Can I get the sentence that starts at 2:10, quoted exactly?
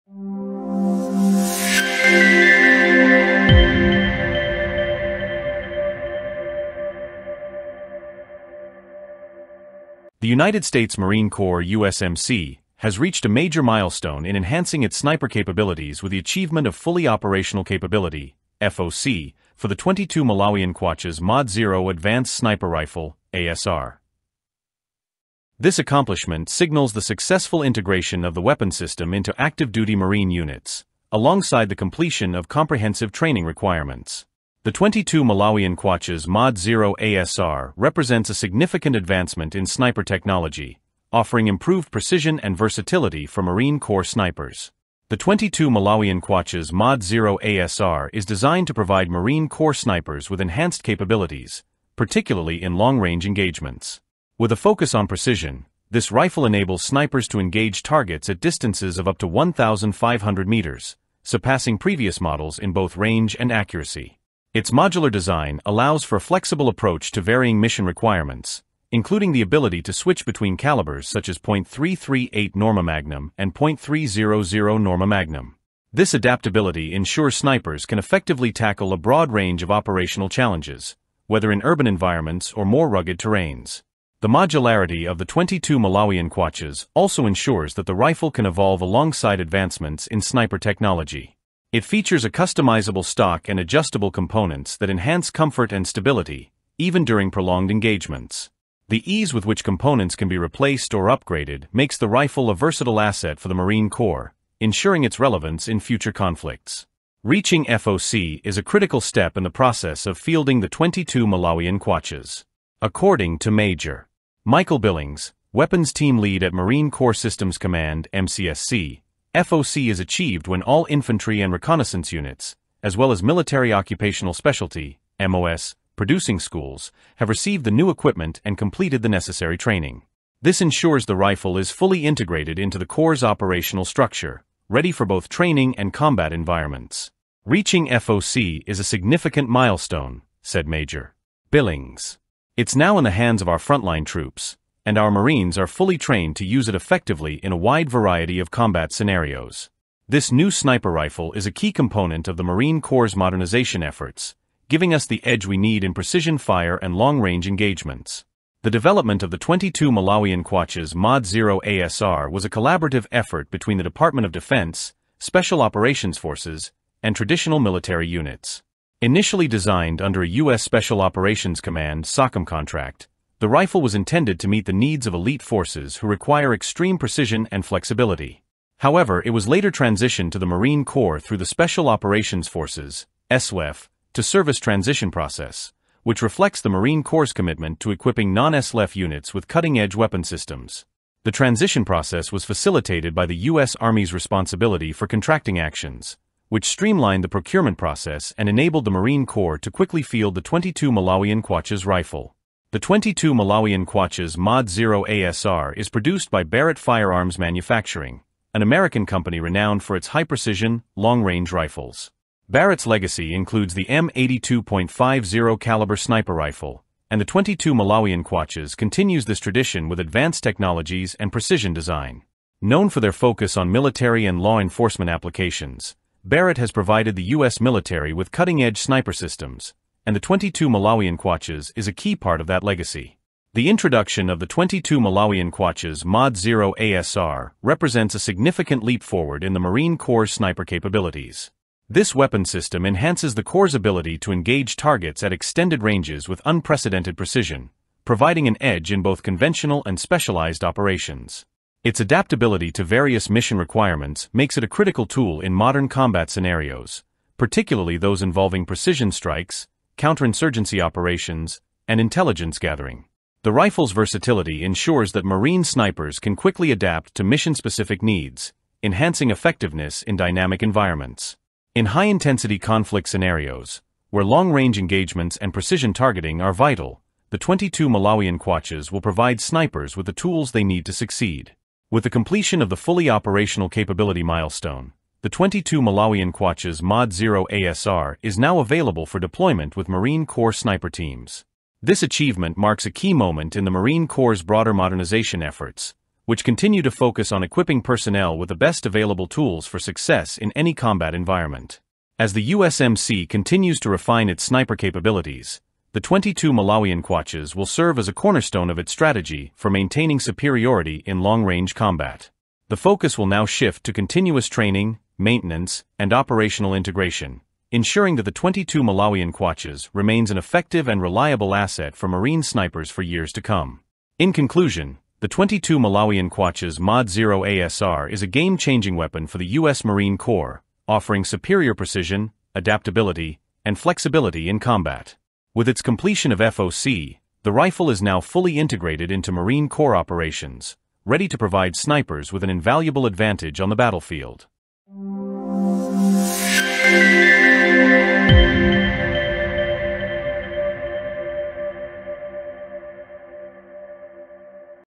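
This ensures the rifle is fully integrated into the Corps' operational structure, ready for both training and combat environments.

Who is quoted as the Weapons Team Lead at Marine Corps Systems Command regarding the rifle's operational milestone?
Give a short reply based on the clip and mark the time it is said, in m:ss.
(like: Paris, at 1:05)
Major Michael Billings, at 1:53.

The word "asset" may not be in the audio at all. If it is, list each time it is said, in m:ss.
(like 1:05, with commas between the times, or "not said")
1:42, 5:21.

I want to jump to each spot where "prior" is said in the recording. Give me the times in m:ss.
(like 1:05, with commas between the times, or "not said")
not said.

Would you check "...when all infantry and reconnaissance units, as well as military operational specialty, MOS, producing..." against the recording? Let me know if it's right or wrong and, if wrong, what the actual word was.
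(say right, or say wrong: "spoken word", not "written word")
wrong: "occupational", not "operational".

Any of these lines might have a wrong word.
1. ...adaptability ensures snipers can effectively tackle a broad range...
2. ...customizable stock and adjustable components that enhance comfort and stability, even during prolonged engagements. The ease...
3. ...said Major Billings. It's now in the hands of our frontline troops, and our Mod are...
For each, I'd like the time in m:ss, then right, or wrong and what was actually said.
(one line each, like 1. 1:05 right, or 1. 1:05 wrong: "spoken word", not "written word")
1. 1:16 right
2. 1:32 right
3. 2:20 wrong: "Marines", not "Mod".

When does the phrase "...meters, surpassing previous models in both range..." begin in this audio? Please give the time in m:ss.
1:00.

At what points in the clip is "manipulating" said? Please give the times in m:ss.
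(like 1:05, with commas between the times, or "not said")
not said.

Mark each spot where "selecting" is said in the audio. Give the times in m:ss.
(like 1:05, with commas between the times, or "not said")
not said.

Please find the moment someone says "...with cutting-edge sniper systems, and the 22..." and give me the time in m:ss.
3:48.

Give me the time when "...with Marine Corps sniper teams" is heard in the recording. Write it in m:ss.
4:49.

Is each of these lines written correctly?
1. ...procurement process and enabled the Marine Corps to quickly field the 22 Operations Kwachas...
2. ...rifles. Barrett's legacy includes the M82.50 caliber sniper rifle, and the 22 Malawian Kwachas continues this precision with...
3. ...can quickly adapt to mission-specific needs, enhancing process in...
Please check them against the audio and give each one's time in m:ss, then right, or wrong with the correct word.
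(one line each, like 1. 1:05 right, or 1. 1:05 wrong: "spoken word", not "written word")
1. 3:17 wrong: "Malawian", not "Operations"
2. 3:31 wrong: "tradition", not "precision"
3. 4:26 wrong: "effectiveness", not "process".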